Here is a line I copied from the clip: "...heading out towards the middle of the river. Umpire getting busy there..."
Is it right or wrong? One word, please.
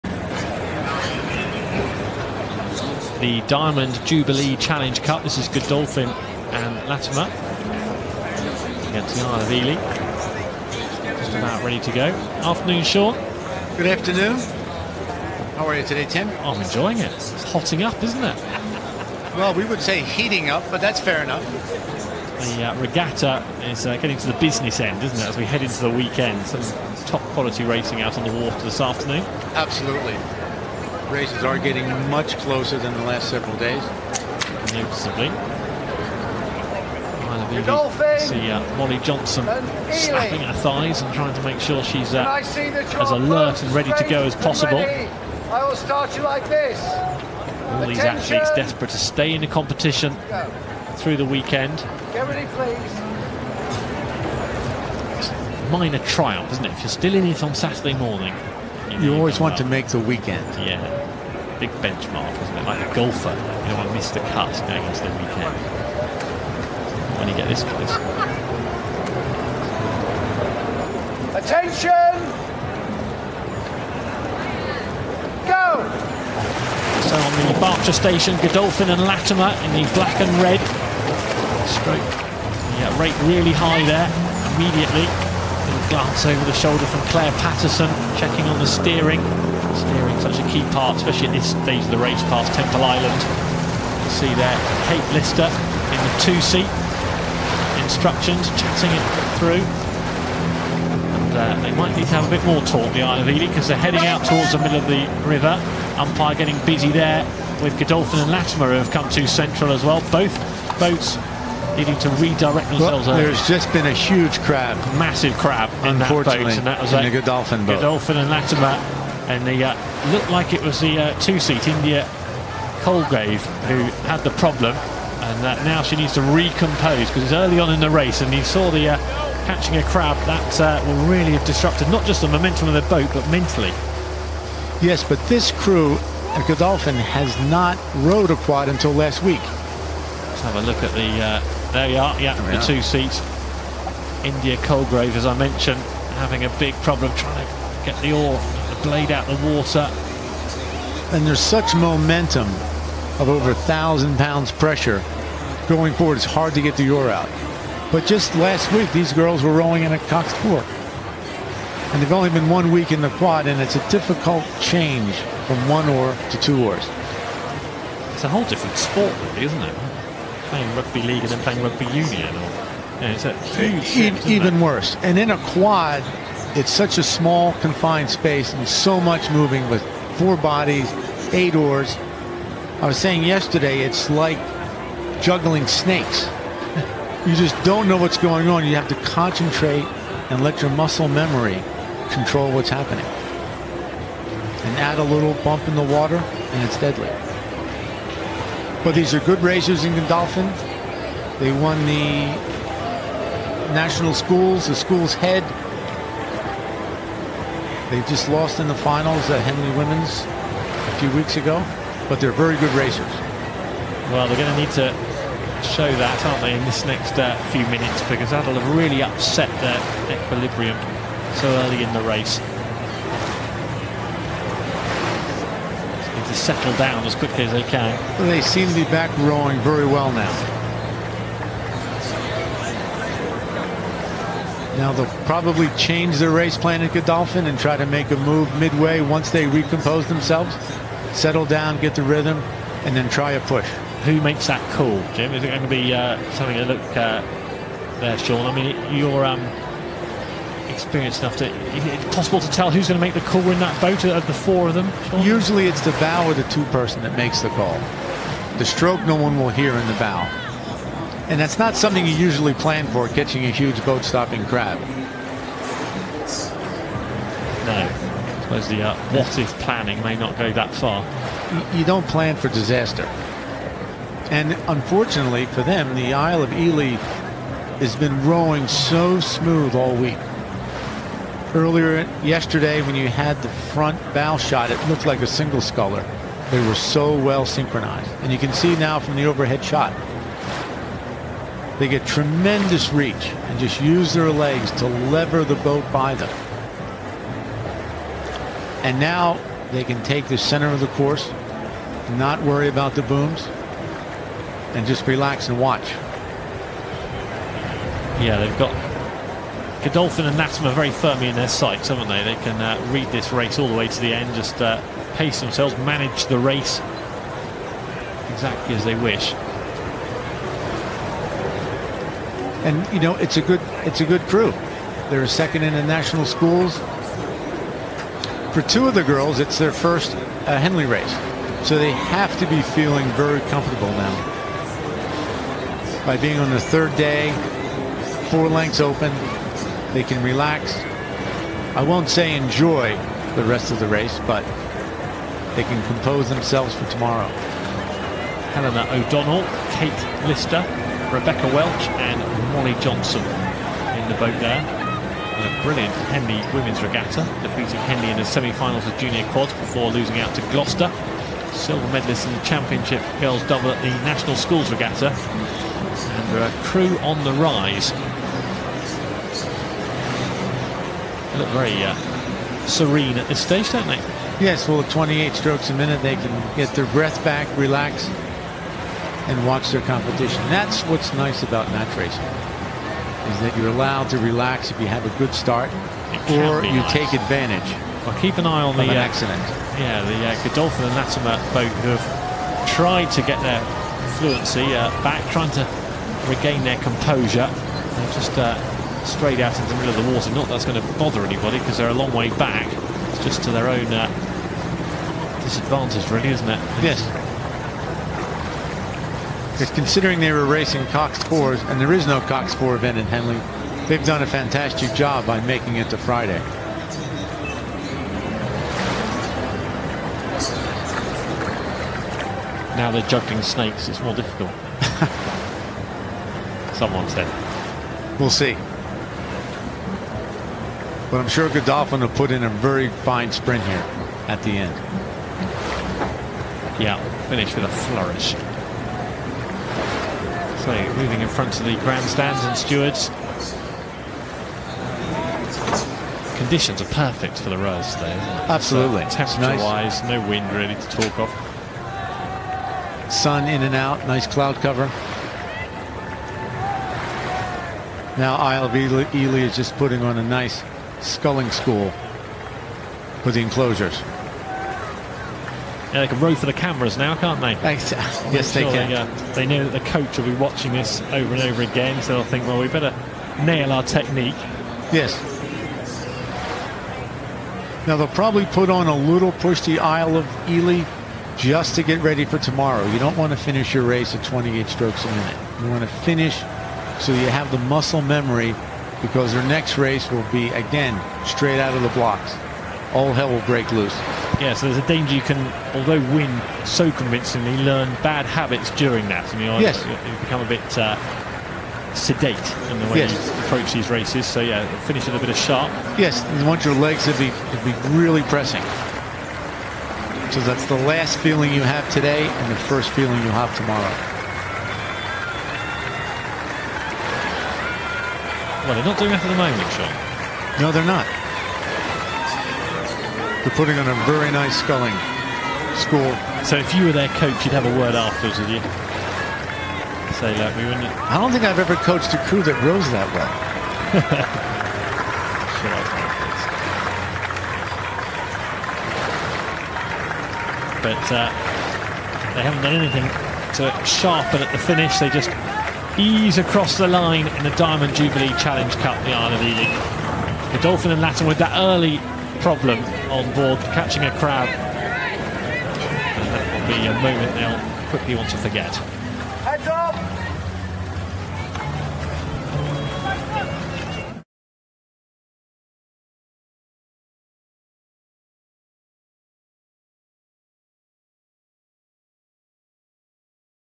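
right.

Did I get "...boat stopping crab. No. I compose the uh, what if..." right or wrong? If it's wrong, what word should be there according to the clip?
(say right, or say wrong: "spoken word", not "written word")
wrong: "suppose", not "compose".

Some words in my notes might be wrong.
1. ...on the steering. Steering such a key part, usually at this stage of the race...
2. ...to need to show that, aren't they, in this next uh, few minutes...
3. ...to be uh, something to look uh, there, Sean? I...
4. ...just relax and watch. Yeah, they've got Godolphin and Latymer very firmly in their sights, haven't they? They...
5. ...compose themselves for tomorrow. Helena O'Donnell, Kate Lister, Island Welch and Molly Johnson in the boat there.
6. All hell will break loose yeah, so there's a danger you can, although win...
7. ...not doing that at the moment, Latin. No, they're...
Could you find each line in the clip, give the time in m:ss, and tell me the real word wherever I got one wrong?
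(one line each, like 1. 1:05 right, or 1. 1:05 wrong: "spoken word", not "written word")
1. 1:28 wrong: "especially", not "usually"
2. 3:34 right
3. 4:05 right
4. 5:04 right
5. 5:45 wrong: "Rebecca", not "Island"
6. 8:12 right
7. 8:38 wrong: "Sean", not "Latin".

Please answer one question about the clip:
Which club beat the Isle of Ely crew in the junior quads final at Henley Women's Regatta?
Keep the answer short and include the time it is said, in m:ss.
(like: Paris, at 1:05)
Gloucester, at 6:00.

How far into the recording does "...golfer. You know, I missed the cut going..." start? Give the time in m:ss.
1:02.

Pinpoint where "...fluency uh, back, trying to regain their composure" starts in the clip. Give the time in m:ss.
6:34.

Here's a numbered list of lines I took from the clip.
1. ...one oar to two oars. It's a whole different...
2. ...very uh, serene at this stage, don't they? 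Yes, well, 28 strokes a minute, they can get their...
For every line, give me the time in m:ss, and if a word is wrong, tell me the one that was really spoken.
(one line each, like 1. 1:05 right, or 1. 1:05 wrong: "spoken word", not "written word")
1. 2:45 right
2. 6:11 right.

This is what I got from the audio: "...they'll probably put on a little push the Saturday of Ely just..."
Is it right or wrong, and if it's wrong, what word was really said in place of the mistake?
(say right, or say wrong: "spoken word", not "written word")
wrong: "Isle", not "Saturday".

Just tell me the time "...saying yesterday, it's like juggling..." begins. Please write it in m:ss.
3:02.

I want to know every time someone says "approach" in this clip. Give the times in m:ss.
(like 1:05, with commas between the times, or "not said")
8:23.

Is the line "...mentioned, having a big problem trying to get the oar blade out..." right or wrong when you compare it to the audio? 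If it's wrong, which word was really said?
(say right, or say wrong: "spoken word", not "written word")
right.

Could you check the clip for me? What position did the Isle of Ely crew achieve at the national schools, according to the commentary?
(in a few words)
Second.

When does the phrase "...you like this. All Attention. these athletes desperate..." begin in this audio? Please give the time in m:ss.
0:46.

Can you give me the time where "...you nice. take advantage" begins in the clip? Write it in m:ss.
6:26.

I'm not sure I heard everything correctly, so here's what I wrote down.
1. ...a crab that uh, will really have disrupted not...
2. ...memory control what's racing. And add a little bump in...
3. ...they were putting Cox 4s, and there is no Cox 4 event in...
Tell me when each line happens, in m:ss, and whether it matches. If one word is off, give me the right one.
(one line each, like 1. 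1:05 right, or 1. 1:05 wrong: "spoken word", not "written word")
1. 2:09 right
2. 3:11 wrong: "happening", not "racing"
3. 6:50 wrong: "racing", not "putting".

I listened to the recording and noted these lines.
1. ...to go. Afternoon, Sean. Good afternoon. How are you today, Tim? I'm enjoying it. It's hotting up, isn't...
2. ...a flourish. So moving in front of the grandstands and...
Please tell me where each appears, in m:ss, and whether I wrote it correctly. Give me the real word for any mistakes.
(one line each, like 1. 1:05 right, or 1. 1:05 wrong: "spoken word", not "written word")
1. 0:11 right
2. 7:17 right.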